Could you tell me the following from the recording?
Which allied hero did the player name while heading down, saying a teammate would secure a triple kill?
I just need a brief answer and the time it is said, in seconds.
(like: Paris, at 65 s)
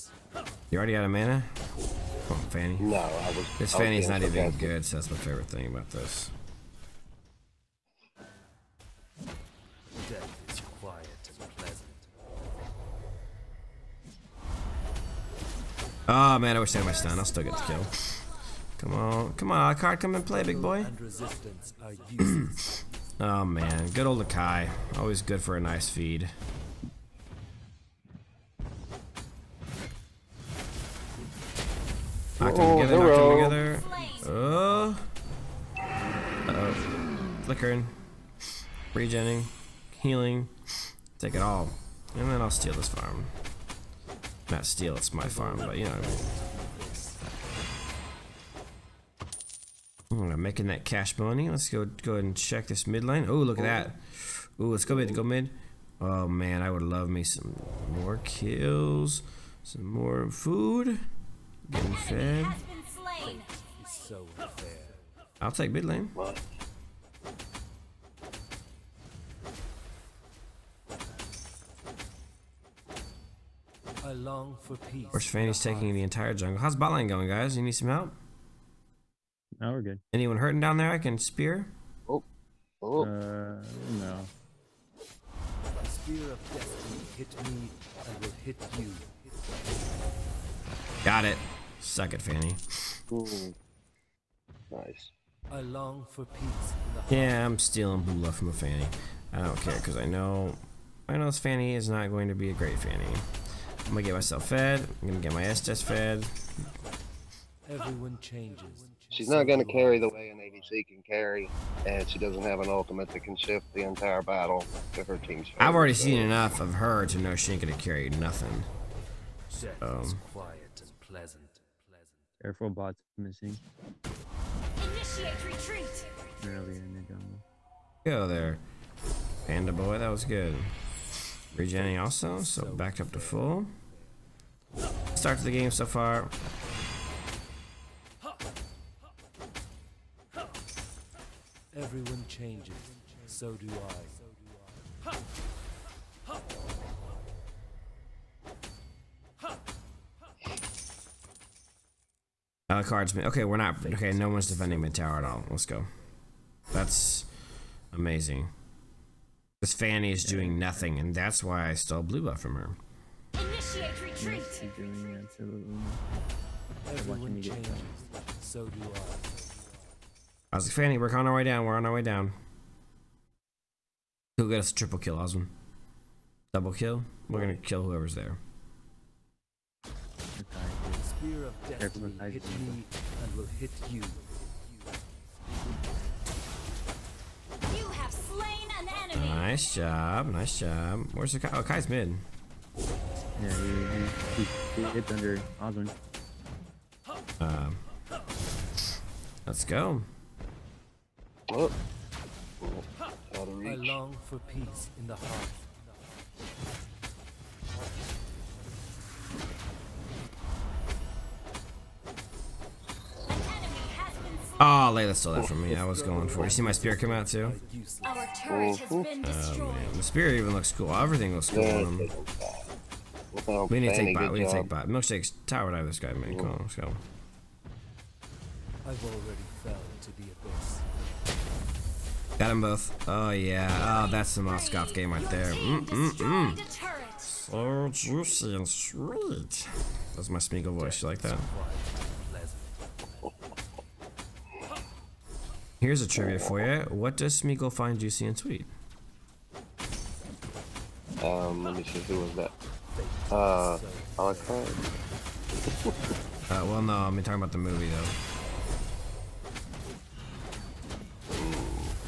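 Osman, at 175 s.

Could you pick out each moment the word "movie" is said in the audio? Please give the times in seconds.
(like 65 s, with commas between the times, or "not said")
257 s.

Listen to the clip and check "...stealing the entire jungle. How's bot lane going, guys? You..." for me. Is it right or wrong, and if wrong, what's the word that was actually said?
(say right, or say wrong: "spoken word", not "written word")
wrong: "taking", not "stealing".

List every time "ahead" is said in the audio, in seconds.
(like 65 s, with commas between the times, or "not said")
52 s.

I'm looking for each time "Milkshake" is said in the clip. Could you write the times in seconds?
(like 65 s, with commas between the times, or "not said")
224 s.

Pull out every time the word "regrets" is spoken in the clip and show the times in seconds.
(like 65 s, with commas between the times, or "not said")
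not said.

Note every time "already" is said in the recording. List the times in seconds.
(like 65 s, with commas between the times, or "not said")
0 s, 115 s, 229 s.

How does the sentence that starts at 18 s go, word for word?
Come on, come on, Alucard, come and play, big boy.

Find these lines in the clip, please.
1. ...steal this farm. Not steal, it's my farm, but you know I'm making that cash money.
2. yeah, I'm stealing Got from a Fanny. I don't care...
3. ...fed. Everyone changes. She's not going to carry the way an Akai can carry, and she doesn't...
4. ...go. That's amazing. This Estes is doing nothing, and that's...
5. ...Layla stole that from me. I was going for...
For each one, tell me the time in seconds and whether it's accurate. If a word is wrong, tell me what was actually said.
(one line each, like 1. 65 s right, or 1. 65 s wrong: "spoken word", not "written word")
1. 42 s right
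2. 97 s wrong: "Bula", not "Got"
3. 105 s wrong: "ADC", not "Akai"
4. 155 s wrong: "Fanny", not "Estes"
5. 214 s right.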